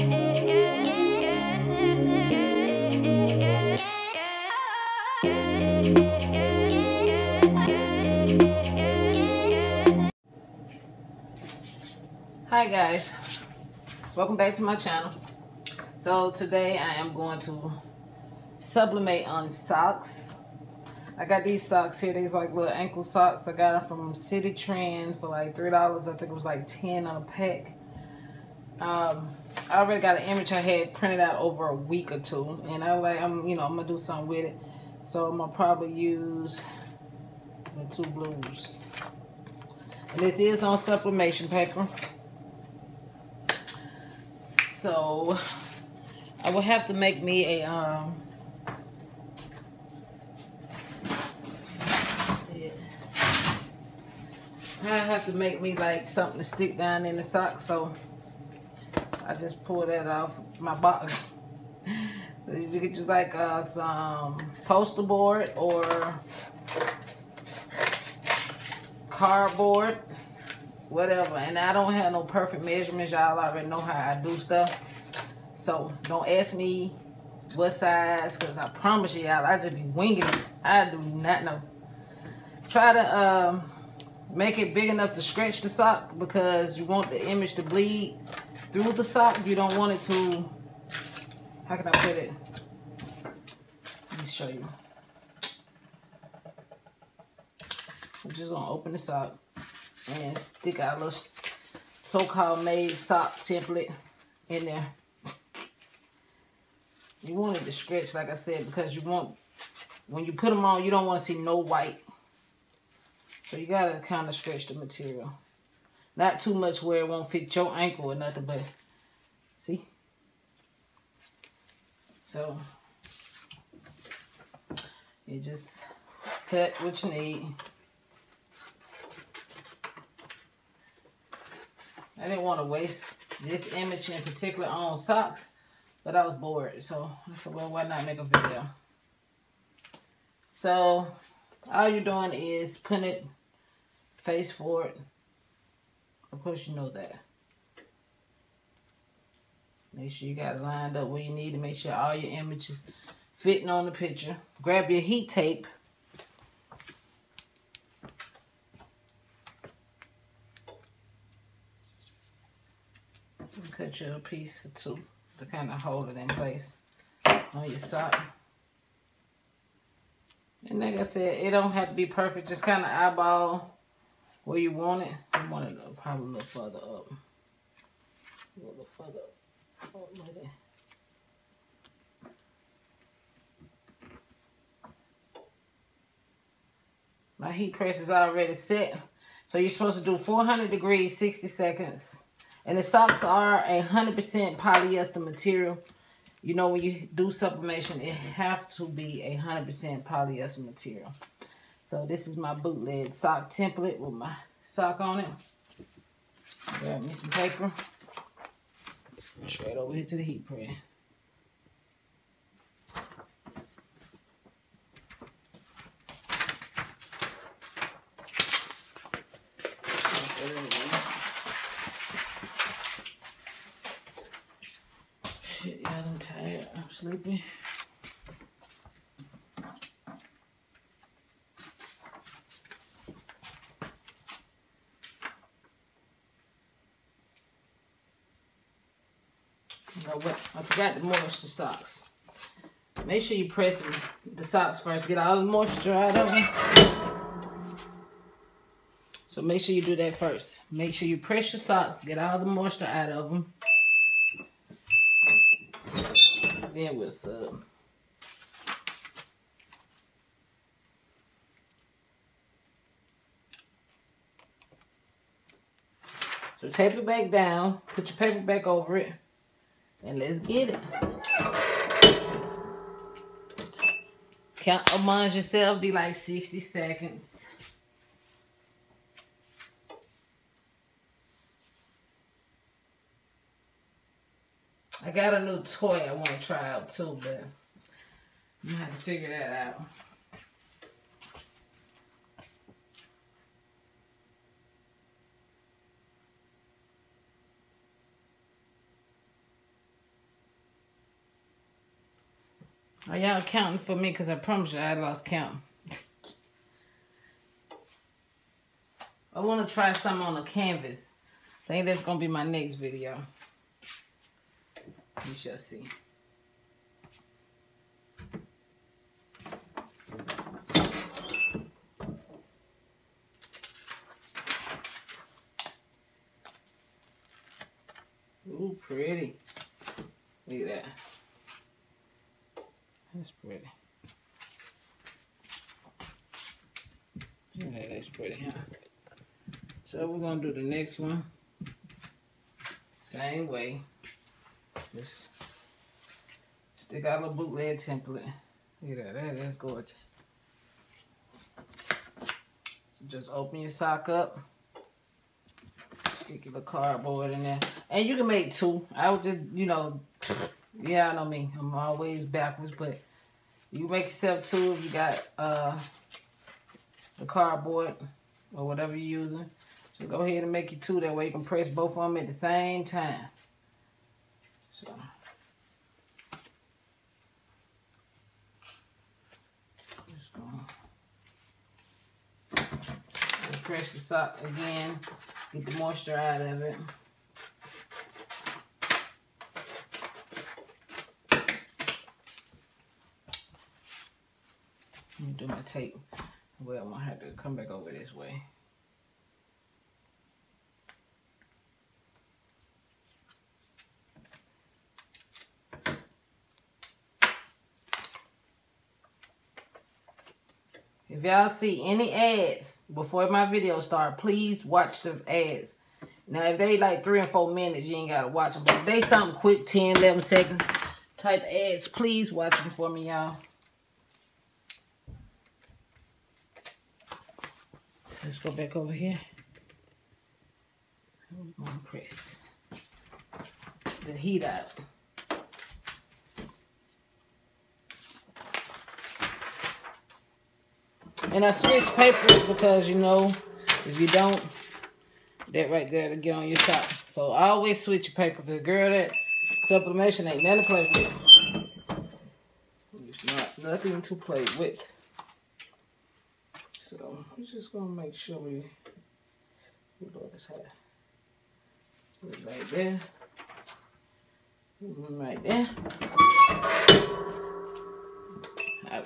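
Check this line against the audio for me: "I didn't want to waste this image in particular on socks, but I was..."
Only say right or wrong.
right.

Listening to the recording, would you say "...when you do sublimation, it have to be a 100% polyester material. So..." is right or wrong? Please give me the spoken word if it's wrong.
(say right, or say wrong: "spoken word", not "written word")
right.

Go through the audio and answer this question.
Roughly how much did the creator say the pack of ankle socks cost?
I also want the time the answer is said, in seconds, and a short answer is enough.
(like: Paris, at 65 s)
$3, at 25 s.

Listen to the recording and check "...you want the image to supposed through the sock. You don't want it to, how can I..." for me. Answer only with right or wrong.
wrong.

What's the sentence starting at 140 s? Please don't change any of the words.
So all you're doing is putting it face forward.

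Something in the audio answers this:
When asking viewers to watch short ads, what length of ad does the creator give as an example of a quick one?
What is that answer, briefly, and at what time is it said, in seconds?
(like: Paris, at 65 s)
10, 11 seconds, at 419 s.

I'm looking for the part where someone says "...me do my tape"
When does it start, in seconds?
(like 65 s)
395 s.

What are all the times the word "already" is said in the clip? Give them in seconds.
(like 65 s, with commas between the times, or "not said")
29 s, 73 s, 188 s.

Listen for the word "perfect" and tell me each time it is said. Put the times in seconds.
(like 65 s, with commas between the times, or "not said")
72 s, 172 s.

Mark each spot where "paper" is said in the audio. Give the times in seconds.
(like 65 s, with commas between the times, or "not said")
41 s, 207 s, 268 s, 441 s, 448 s.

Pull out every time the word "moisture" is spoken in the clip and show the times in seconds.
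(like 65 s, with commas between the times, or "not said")
240 s, 245 s, 252 s, 385 s.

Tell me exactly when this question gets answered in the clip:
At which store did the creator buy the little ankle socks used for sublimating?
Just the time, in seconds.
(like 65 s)
24 s.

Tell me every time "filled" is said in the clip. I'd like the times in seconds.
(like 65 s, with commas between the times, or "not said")
not said.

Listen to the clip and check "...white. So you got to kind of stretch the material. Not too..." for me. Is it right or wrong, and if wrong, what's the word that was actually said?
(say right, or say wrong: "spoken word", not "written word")
right.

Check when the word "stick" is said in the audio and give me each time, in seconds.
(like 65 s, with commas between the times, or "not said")
56 s, 100 s, 346 s, 356 s.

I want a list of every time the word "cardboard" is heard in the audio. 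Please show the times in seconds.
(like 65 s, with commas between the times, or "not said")
69 s, 356 s, 367 s.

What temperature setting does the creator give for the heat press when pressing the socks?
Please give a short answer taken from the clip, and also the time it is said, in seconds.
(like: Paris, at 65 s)
400 degrees, at 190 s.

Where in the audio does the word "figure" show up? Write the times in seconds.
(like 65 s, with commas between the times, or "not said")
289 s.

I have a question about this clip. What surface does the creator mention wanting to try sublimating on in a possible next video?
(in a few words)
canvas.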